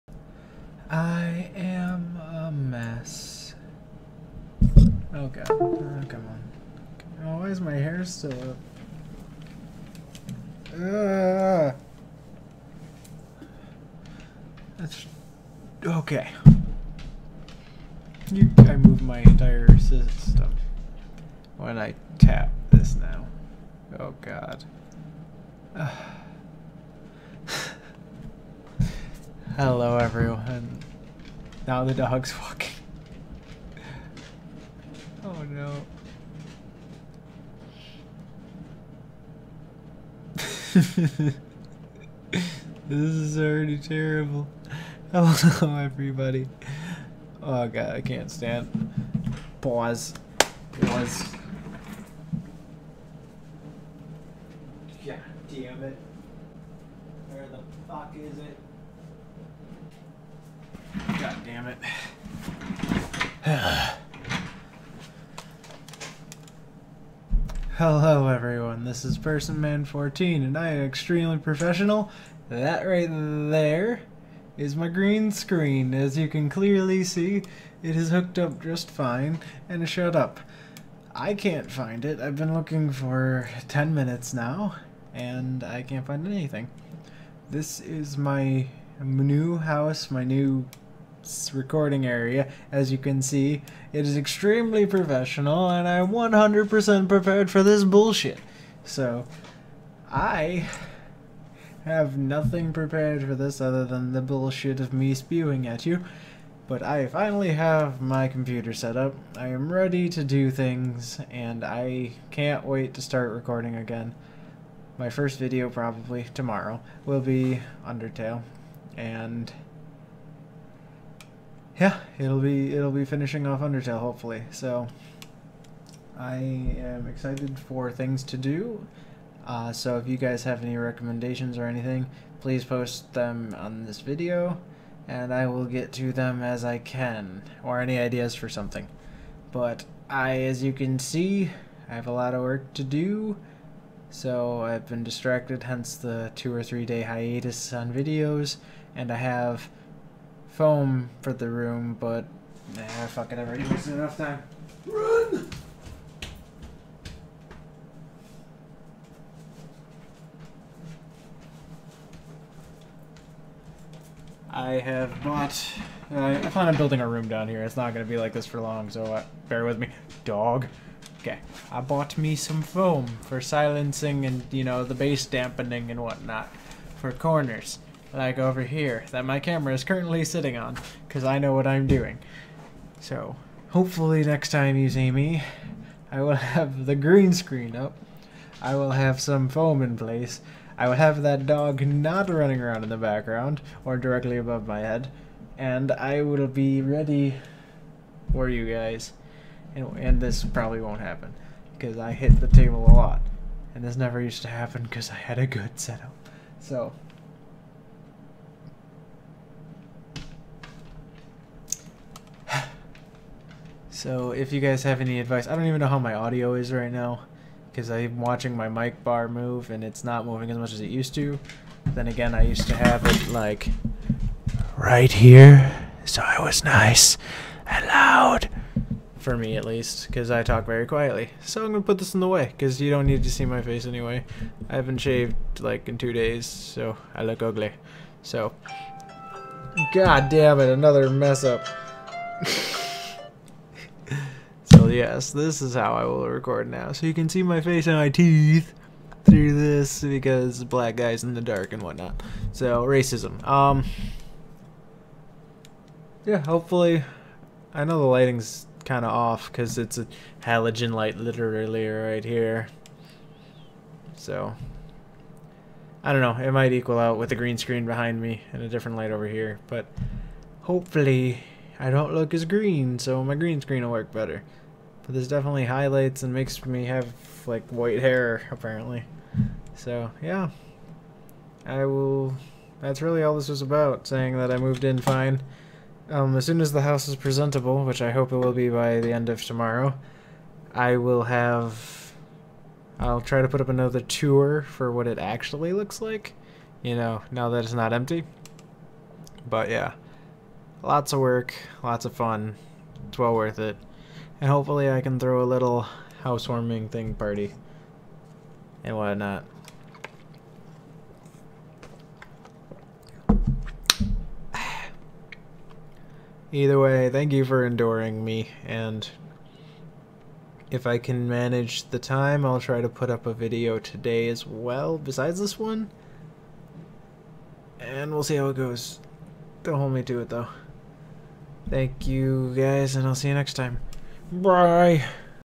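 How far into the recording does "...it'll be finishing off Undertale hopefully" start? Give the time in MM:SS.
02:02.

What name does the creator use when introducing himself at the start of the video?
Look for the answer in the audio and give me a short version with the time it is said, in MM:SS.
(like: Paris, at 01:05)
Personman14, at 01:09.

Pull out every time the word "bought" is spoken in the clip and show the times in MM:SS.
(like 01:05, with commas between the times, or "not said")
02:45, 02:51.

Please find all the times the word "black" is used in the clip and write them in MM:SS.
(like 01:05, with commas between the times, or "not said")
04:10.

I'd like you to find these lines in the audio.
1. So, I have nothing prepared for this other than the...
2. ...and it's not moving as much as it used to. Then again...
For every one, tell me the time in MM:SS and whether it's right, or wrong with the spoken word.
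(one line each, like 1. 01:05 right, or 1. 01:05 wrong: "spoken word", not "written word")
1. 01:38 right
2. 03:39 right.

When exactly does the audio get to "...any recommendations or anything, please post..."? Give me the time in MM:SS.
02:10.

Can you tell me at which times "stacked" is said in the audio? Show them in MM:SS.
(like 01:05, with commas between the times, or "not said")
not said.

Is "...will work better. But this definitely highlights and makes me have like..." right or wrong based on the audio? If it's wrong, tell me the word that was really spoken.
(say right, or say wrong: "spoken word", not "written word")
right.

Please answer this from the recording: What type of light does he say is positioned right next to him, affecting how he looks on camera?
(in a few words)
halogen light.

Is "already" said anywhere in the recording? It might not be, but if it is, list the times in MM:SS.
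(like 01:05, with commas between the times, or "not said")
00:43, 02:33.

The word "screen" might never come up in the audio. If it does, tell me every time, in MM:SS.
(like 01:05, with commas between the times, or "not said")
01:15, 03:07, 04:27, 04:33.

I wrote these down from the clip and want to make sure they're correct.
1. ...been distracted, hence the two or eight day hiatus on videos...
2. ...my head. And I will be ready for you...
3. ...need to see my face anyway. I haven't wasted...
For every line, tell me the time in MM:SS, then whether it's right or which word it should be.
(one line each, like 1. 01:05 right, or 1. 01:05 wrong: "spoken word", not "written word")
1. 02:24 wrong: "three", not "eight"
2. 03:14 right
3. 03:53 wrong: "shaved", not "wasted".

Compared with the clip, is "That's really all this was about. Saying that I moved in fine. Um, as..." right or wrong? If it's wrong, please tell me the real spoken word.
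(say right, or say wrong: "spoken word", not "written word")
right.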